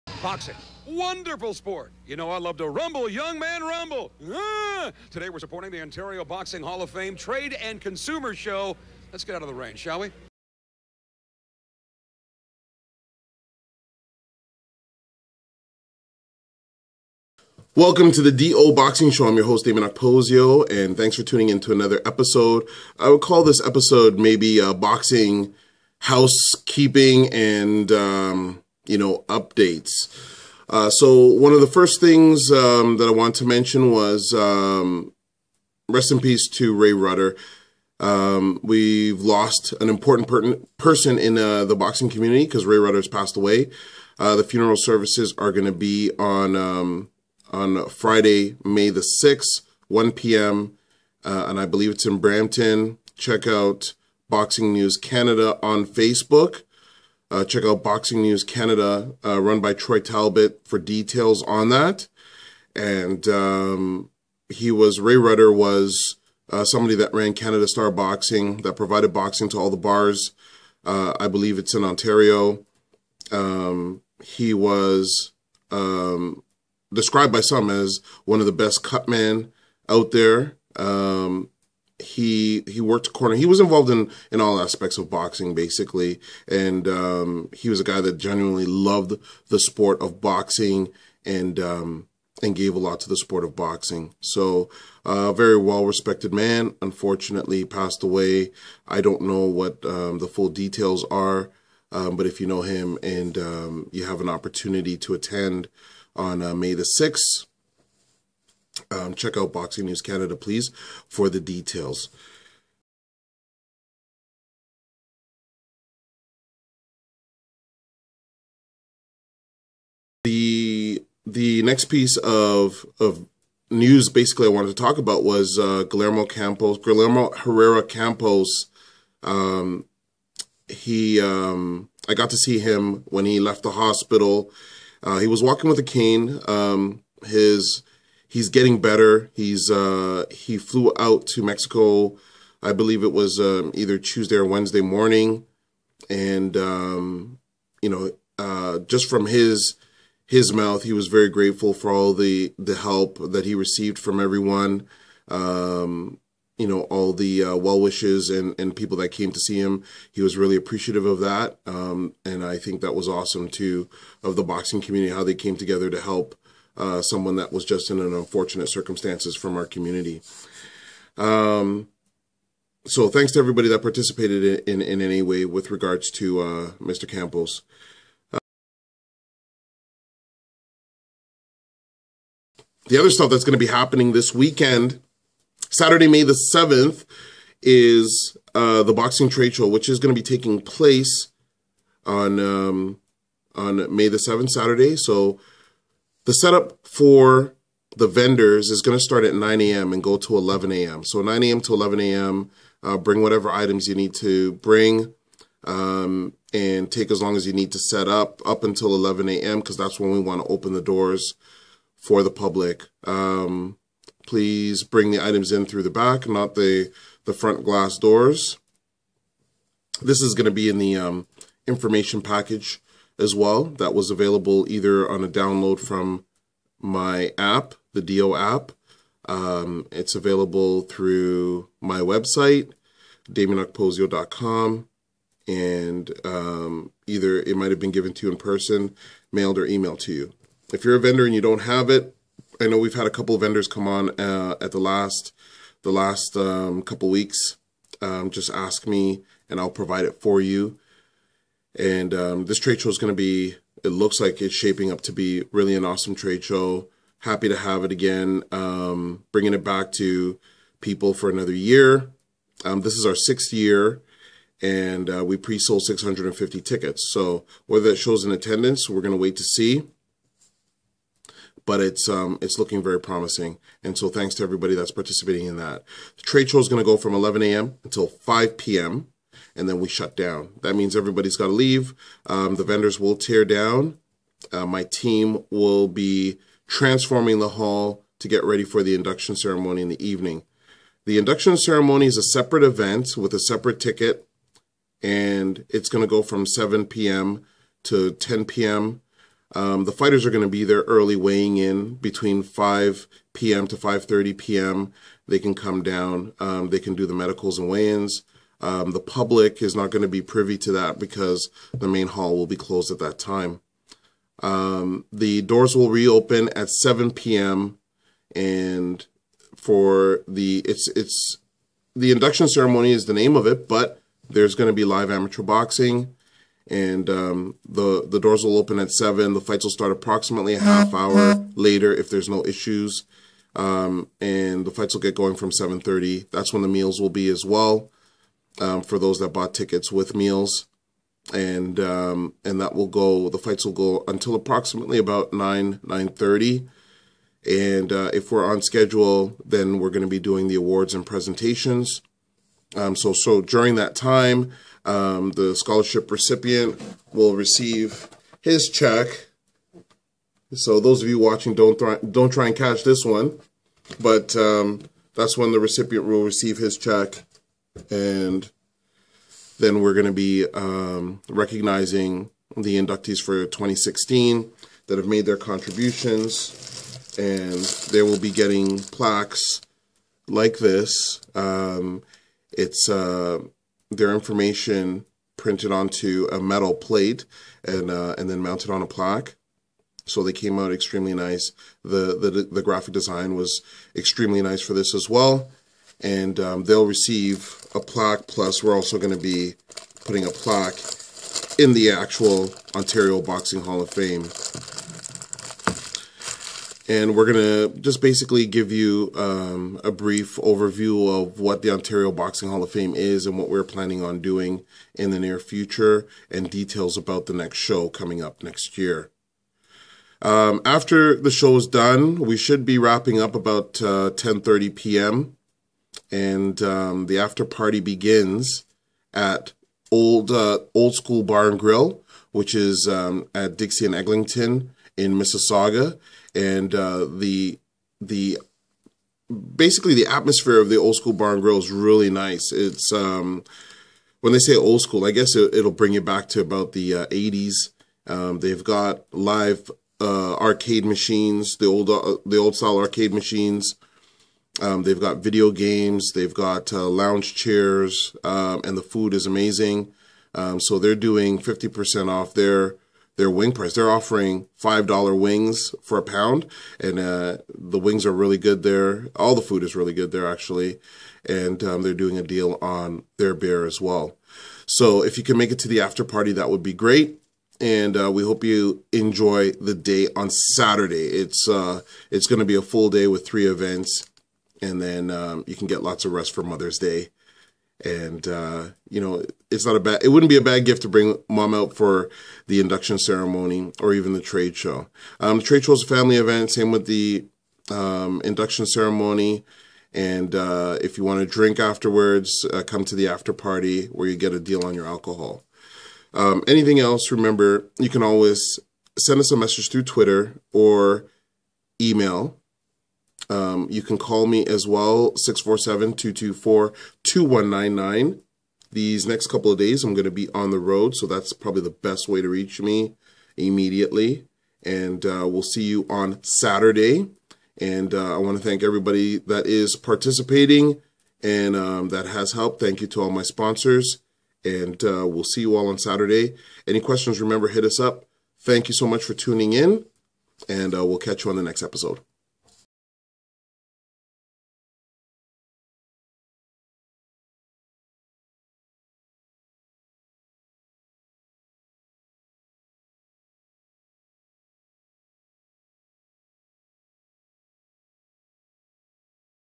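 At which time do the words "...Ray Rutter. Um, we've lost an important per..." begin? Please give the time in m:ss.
0:36.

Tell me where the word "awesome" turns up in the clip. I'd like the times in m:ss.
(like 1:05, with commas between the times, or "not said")
2:43, 4:15.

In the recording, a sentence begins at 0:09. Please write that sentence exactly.
Let's get out of the rain, shall we?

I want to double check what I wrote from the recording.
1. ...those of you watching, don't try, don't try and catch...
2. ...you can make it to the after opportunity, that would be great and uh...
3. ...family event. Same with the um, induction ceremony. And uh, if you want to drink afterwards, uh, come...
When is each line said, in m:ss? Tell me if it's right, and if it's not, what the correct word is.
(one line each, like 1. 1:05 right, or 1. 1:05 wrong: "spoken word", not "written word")
1. 6:00 right
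2. 7:55 wrong: "party", not "opportunity"
3. 8:15 right.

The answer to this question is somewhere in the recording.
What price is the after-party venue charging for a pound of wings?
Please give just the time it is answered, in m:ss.
7:44.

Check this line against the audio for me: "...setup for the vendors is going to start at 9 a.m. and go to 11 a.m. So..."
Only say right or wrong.
right.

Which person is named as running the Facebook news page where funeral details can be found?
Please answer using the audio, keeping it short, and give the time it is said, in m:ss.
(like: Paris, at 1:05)
Troy Talbot, at 0:59.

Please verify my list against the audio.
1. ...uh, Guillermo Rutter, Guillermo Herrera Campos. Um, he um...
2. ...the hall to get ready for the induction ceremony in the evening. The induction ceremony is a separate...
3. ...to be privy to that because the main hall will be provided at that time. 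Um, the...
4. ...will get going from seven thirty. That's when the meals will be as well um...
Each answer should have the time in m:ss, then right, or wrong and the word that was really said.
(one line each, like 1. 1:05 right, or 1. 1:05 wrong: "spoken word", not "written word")
1. 2:05 wrong: "Campos", not "Rutter"
2. 4:47 right
3. 5:10 wrong: "closed", not "provided"
4. 5:34 right.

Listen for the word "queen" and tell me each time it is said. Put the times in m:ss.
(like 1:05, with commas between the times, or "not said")
not said.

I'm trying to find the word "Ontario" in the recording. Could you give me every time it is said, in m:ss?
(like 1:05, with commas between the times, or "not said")
0:05, 1:11, 6:42, 6:51.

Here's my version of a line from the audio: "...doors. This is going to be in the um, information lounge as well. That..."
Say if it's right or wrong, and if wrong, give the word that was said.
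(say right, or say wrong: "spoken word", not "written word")
wrong: "package", not "lounge".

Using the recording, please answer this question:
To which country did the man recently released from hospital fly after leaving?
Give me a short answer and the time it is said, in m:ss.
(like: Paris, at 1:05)
Mexico, at 2:21.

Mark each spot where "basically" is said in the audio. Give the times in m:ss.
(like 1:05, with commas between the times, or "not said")
1:25, 2:04, 6:48, 7:19.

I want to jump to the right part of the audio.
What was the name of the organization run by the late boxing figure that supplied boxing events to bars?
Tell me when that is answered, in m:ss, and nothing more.
1:07.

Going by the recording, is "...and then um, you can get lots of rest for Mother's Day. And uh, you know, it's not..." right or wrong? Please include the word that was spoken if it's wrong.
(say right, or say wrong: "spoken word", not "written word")
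right.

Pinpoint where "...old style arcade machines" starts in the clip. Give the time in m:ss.
7:32.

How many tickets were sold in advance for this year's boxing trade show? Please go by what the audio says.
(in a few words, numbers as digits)
650.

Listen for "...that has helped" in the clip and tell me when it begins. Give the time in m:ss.
8:51.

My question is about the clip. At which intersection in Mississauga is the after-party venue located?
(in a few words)
Dixie and Eglinton.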